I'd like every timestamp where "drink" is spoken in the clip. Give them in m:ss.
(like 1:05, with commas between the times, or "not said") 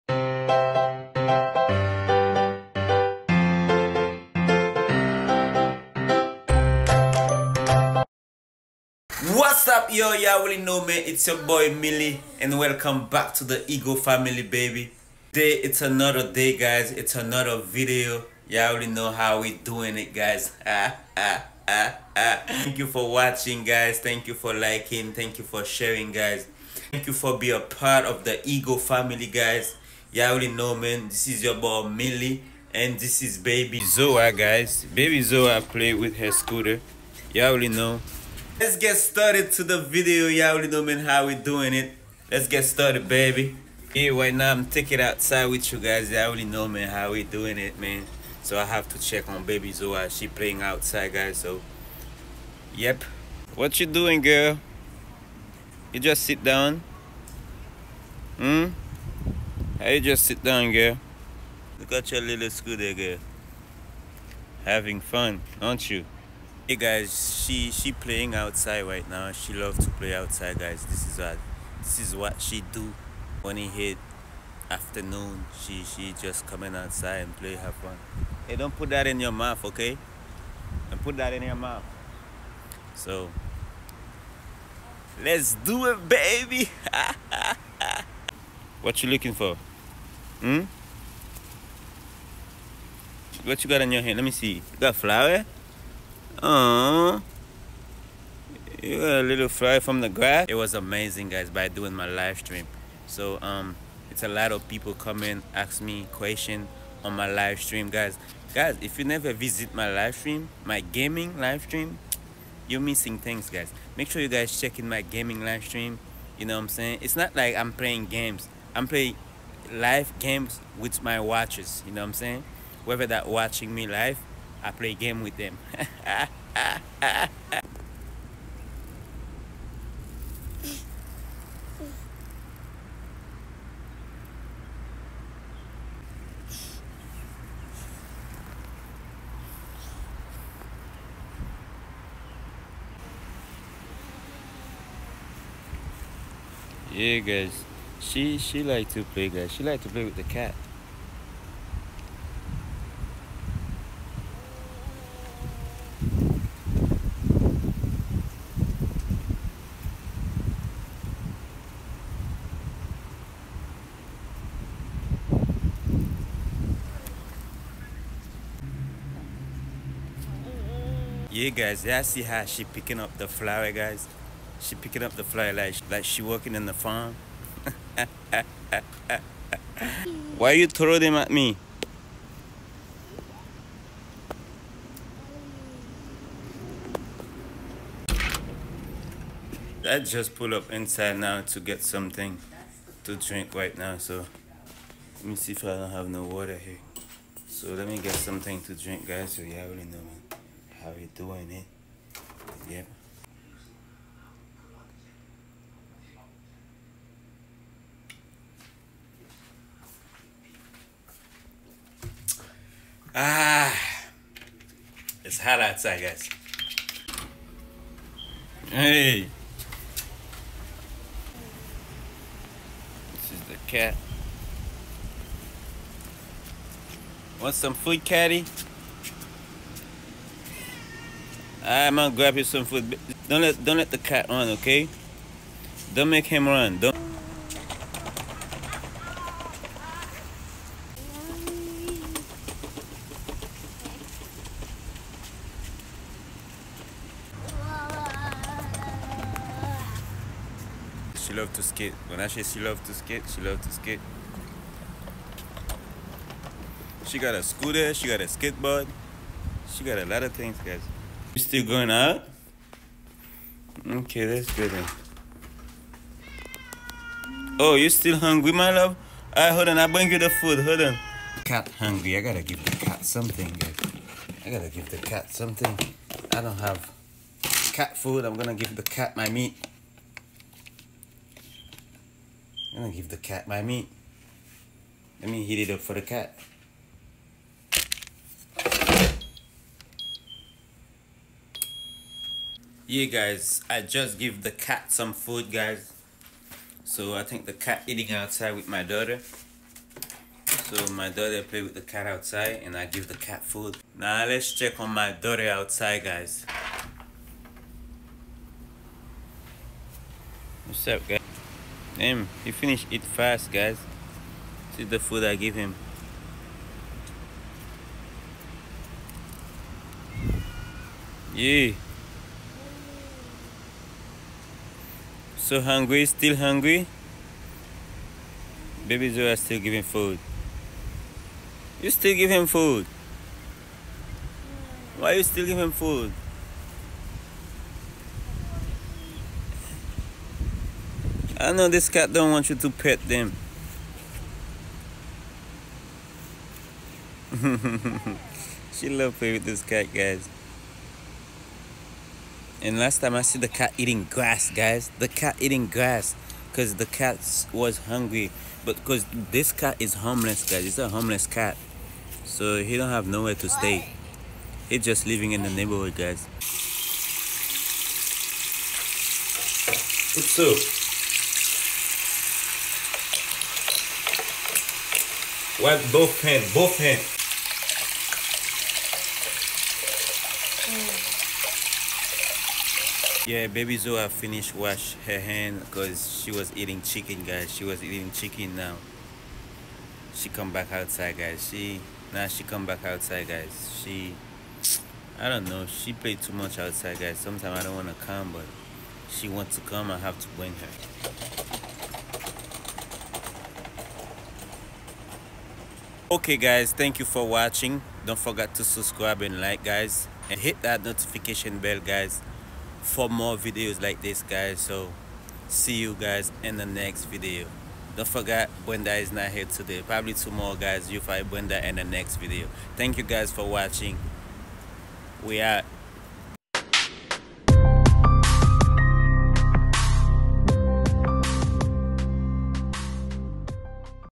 3:13, 3:18.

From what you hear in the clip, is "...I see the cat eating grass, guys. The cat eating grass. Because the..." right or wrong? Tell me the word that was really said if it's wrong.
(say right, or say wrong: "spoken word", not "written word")
right.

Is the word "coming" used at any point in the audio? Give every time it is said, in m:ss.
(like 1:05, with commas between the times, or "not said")
1:16.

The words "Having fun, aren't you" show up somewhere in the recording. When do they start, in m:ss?
1:04.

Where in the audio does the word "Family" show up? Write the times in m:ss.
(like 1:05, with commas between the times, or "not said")
0:13, 0:28.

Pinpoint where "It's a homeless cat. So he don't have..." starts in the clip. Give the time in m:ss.
6:00.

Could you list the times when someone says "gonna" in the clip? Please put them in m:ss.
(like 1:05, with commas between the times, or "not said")
3:51, 4:38, 4:42.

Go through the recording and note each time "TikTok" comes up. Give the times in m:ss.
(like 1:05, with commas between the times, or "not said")
not said.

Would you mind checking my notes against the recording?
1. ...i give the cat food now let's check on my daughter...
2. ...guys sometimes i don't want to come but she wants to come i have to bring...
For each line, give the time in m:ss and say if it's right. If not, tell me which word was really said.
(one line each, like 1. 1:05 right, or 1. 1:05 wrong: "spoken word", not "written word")
1. 5:02 right
2. 6:36 right.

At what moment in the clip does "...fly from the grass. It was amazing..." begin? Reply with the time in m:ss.
1:39.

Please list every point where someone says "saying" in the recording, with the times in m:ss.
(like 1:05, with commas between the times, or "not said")
1:56, 2:02.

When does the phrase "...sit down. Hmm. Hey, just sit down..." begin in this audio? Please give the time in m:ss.
0:56.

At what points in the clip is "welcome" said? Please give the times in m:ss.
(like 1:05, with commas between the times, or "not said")
0:12.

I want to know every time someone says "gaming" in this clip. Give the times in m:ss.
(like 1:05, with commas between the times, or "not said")
1:50, 1:55.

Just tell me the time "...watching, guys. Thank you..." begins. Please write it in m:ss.
0:23.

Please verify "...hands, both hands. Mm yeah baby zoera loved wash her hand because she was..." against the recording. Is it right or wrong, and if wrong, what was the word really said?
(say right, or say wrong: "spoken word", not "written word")
wrong: "finished", not "loved".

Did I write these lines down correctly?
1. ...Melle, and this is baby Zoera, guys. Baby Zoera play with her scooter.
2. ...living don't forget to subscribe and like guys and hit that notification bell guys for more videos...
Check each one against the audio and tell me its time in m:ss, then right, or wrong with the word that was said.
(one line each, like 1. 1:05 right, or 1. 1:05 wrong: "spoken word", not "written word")
1. 0:31 right
2. 6:47 wrong: "watching", not "living".